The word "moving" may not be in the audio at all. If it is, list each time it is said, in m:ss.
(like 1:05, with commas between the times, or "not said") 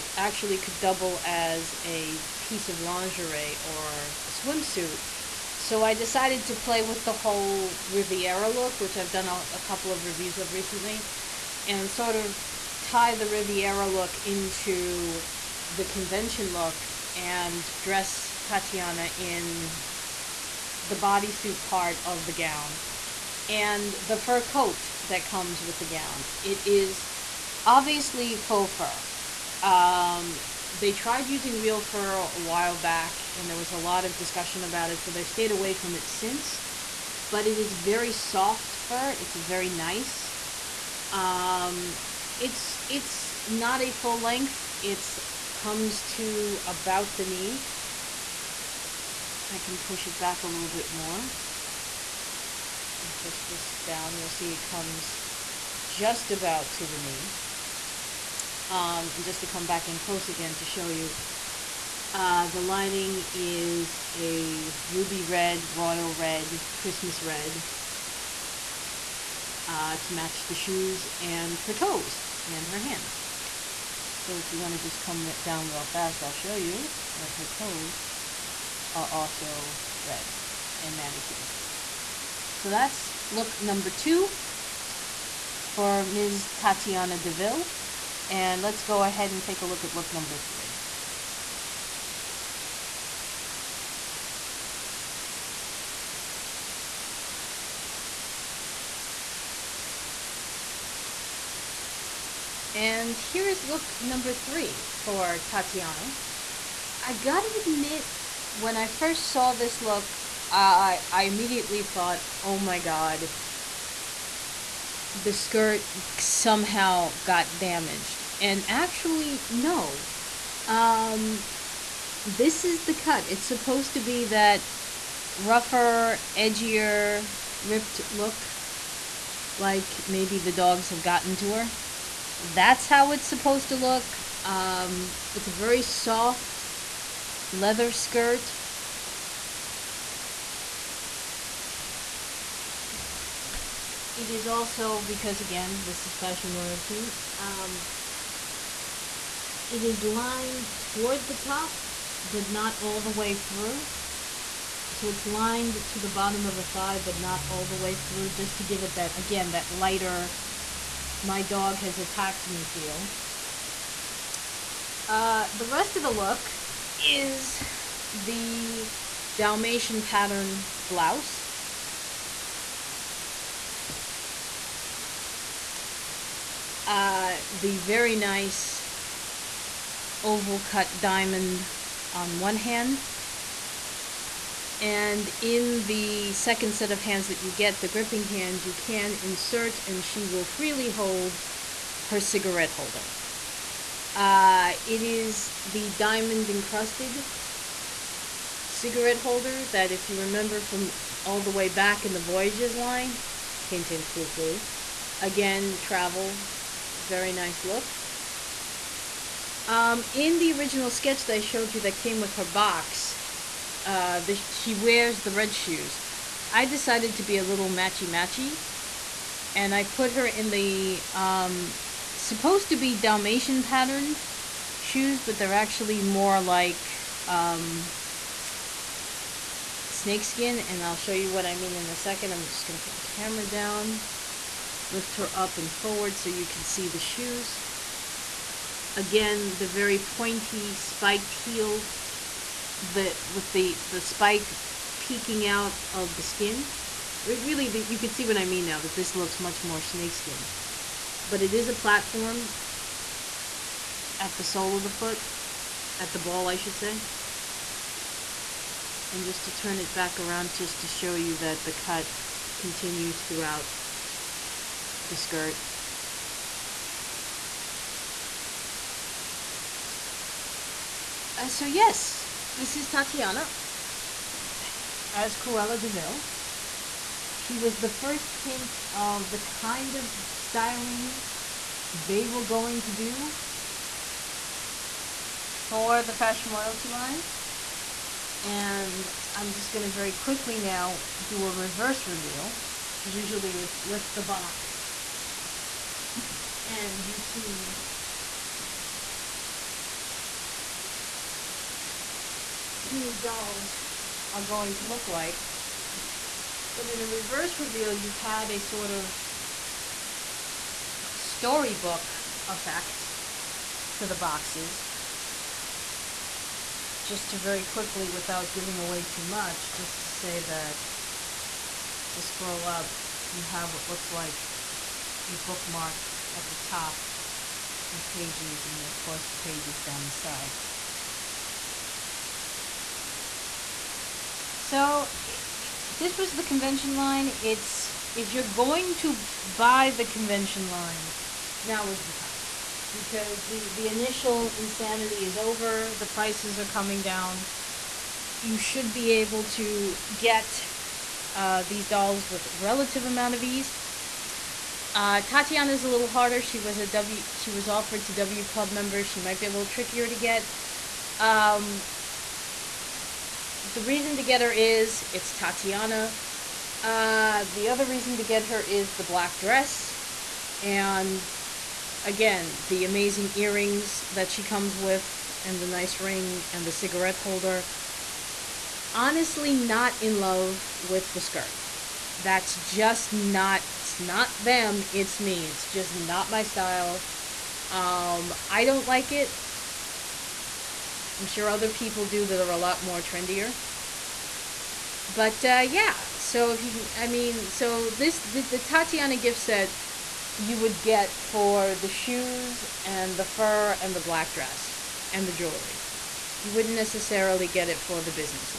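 not said.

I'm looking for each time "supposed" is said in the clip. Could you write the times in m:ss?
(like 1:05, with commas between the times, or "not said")
2:03, 2:13, 3:42.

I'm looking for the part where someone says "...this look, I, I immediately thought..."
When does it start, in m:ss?
1:49.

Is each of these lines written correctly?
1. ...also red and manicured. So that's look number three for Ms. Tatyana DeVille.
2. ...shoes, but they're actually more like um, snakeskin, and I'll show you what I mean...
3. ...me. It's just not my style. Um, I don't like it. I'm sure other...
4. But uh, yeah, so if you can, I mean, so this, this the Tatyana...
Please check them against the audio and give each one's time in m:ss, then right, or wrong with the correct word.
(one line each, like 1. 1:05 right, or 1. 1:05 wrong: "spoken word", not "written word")
1. 1:19 wrong: "two", not "three"
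2. 3:44 right
3. 6:25 right
4. 6:35 right.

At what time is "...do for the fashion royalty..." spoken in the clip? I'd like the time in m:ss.
4:42.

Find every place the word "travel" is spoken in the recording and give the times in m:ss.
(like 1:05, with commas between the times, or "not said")
3:25.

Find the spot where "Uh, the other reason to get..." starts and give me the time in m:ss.
6:06.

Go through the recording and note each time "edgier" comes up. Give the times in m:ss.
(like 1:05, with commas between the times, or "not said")
2:06.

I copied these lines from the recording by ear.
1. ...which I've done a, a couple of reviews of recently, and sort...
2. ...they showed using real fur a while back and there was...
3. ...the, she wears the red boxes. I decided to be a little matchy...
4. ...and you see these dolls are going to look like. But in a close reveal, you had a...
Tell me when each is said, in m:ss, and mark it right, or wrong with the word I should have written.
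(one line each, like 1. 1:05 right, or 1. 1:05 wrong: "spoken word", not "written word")
1. 0:08 right
2. 0:30 wrong: "tried", not "showed"
3. 3:34 wrong: "shoes", not "boxes"
4. 4:56 wrong: "reverse", not "close".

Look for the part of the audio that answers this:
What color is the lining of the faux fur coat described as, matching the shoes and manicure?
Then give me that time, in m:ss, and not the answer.
1:04.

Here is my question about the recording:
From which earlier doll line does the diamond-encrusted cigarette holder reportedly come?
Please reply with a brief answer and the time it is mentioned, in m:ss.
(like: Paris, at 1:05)
Voyages, at 3:22.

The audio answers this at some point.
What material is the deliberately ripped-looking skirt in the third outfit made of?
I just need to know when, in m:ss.
2:17.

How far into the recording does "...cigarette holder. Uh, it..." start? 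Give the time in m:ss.
3:12.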